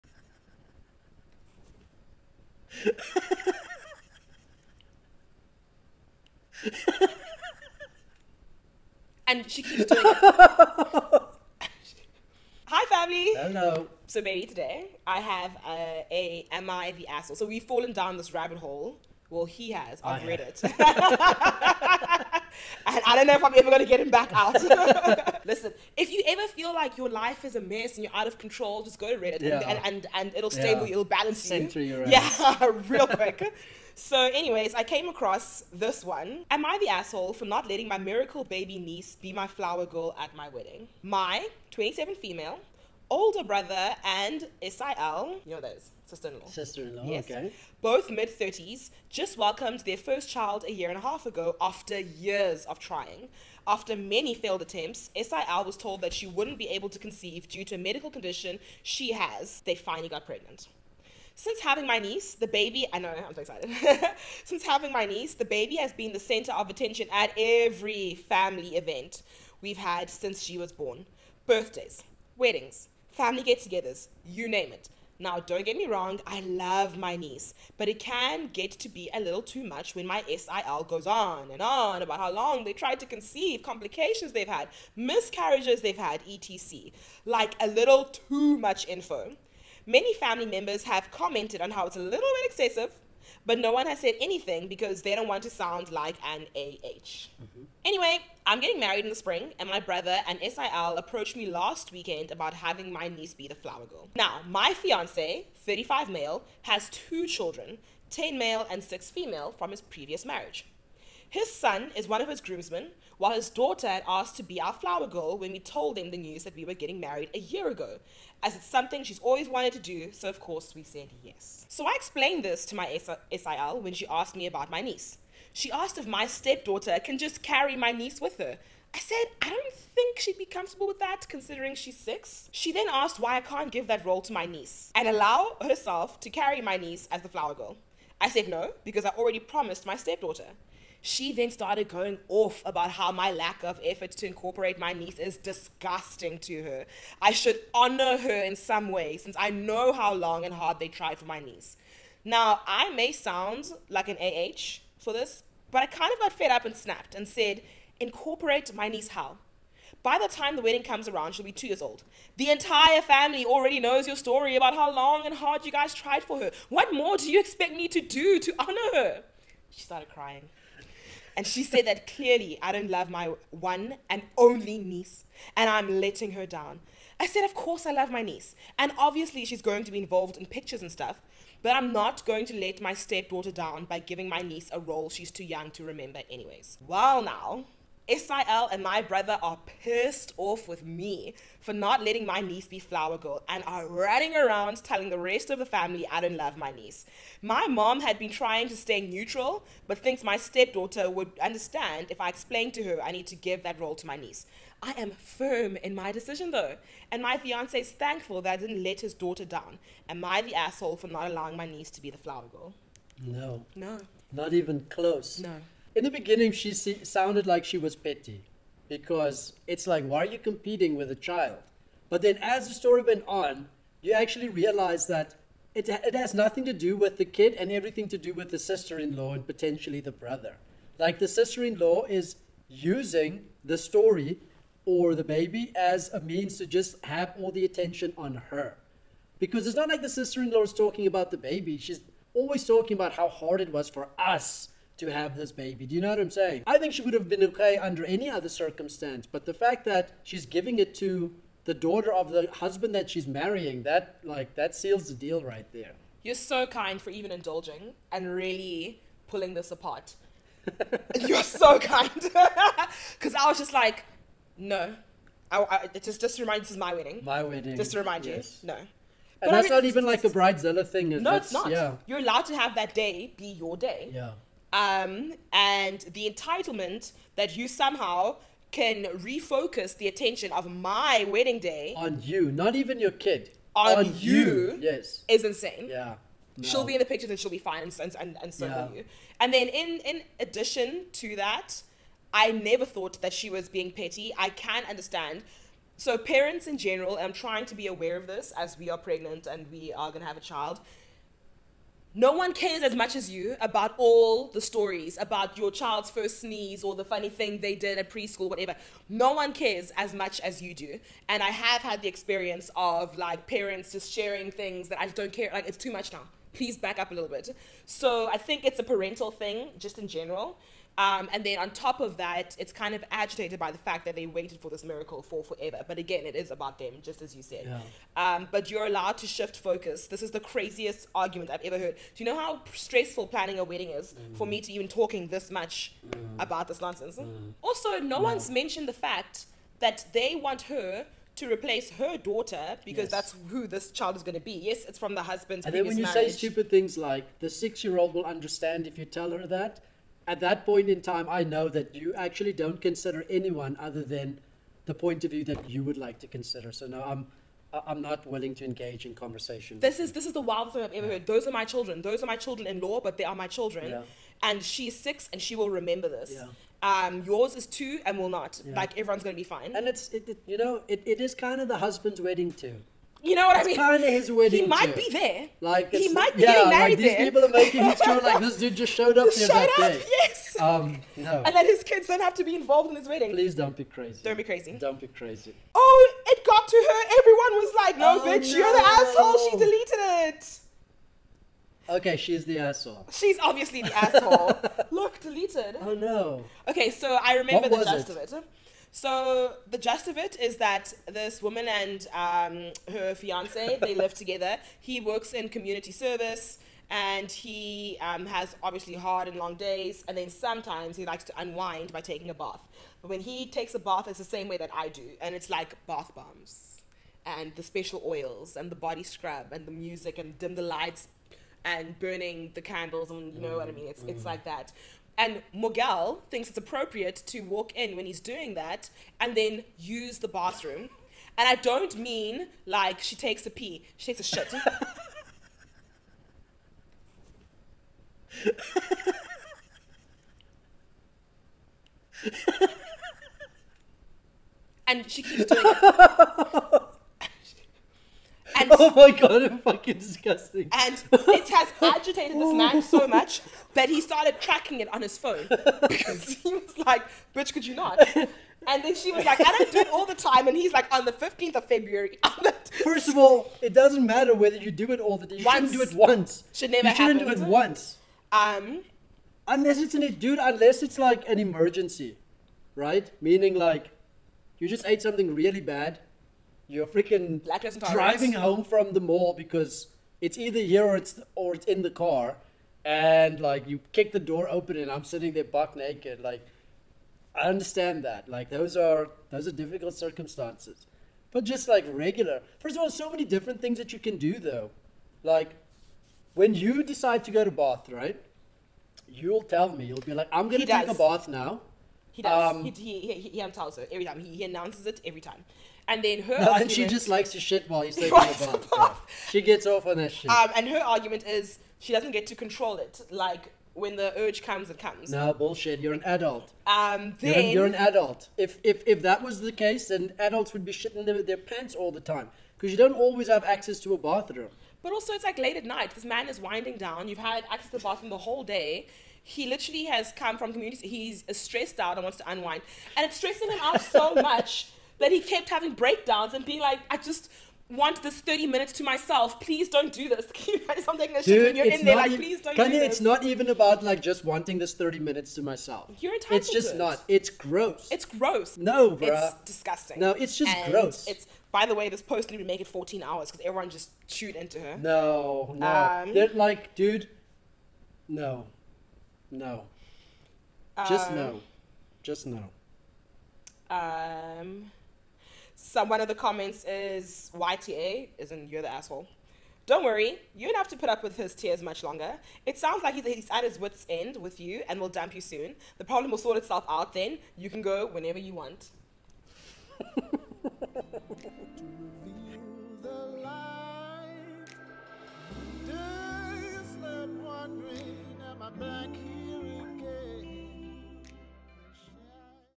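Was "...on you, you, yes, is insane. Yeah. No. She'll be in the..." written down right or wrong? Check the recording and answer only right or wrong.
right.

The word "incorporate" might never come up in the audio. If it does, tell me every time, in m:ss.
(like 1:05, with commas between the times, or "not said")
2:24, 2:37.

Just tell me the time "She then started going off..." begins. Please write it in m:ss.
2:21.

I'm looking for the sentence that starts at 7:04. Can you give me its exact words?
it's like that and Mogal thinks it's appropriate to walk in when he's doing that and then use the bathroom.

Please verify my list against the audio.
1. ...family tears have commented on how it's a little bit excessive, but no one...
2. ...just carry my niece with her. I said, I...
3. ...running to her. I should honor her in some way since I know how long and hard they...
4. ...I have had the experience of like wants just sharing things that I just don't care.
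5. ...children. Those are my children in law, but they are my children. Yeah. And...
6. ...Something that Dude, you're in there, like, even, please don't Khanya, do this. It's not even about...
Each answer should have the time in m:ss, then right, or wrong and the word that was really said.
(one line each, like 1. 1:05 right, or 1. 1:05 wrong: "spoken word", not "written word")
1. 1:30 wrong: "members", not "tears"
2. 2:07 right
3. 2:25 wrong: "disgusting", not "running"
4. 5:11 wrong: "parents", not "wants"
5. 6:01 right
6. 9:00 right.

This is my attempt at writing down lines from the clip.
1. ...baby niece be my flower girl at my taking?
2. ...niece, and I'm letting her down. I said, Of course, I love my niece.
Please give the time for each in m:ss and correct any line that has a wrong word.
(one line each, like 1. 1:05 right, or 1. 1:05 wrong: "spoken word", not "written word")
1. 0:38 wrong: "wedding", not "taking"
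2. 2:54 right.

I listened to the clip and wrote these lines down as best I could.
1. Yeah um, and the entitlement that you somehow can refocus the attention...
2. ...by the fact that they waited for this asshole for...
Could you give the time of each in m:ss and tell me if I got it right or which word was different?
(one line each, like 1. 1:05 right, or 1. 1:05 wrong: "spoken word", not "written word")
1. 4:34 right
2. 5:23 wrong: "miracle", not "asshole".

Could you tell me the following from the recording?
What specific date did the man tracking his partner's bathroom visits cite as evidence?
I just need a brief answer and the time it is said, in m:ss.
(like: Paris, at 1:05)
February 15, at 7:41.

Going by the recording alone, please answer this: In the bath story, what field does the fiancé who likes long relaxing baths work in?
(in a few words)
Community service.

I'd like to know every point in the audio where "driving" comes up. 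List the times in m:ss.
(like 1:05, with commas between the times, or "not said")
7:57.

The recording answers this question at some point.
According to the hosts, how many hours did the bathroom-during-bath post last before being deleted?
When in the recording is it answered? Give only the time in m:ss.
9:12.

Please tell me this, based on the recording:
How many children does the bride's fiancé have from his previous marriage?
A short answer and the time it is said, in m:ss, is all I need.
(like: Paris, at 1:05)
2, at 1:46.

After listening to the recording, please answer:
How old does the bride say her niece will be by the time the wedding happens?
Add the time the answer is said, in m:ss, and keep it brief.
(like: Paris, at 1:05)
2, at 2:41.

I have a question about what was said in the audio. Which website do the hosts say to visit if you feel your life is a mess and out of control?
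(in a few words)
Reddit.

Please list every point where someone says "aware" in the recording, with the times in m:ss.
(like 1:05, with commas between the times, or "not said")
4:57.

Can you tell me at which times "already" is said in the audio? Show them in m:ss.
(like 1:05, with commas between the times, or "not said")
2:19, 2:43.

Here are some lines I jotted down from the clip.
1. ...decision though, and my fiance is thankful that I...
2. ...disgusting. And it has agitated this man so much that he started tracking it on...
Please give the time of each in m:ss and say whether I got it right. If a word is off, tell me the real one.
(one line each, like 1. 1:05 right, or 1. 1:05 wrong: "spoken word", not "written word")
1. 3:26 right
2. 7:29 right.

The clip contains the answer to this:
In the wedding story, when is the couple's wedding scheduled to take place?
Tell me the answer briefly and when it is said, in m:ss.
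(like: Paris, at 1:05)
In the spring, at 1:39.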